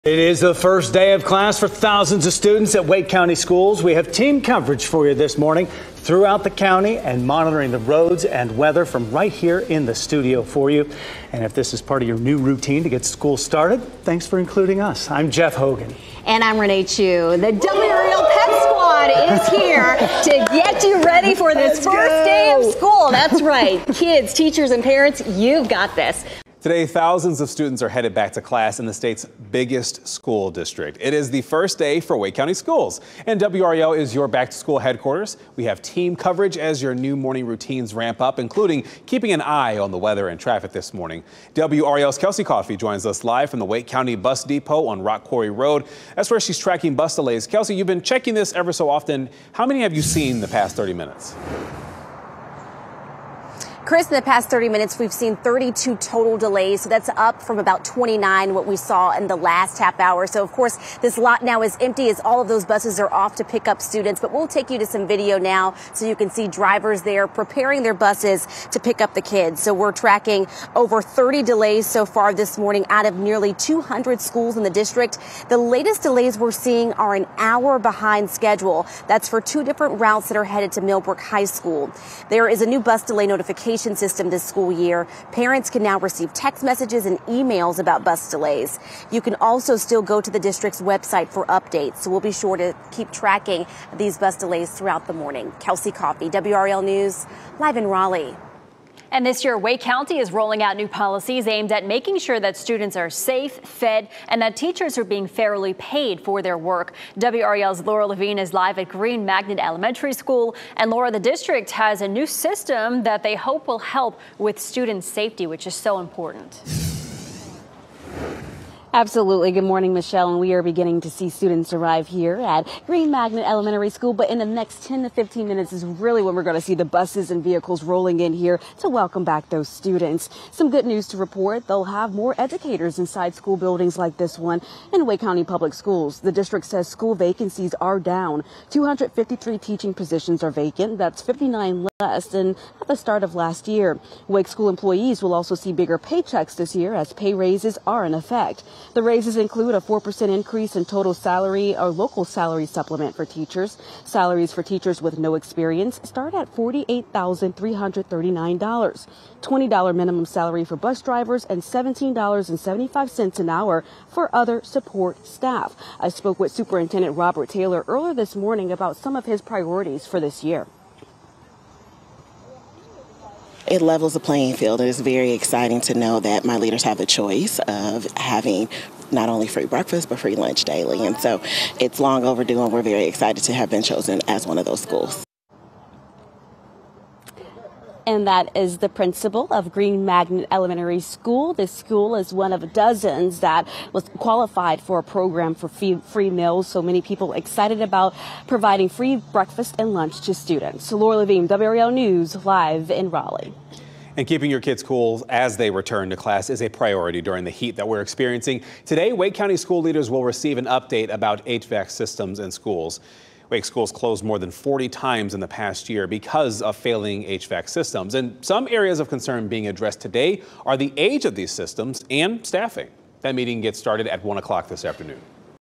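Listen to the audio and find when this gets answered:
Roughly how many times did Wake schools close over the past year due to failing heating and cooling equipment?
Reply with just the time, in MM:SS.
03:34.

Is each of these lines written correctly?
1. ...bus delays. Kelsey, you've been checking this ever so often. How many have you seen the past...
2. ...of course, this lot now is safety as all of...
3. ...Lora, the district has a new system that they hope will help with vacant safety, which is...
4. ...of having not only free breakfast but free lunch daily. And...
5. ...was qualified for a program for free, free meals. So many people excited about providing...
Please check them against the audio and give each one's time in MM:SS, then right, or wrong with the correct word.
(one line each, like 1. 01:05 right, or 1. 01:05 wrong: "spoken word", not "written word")
1. 00:46 right
2. 01:00 wrong: "empty", not "safety"
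3. 01:50 wrong: "student", not "vacant"
4. 02:57 right
5. 03:13 right.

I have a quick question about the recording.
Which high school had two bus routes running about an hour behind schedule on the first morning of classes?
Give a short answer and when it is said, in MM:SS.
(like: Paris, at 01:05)
Millbrook High School, at 01:20.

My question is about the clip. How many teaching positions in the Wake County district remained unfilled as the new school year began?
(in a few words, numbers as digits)
253.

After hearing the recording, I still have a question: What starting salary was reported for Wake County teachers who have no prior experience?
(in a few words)
$48,339.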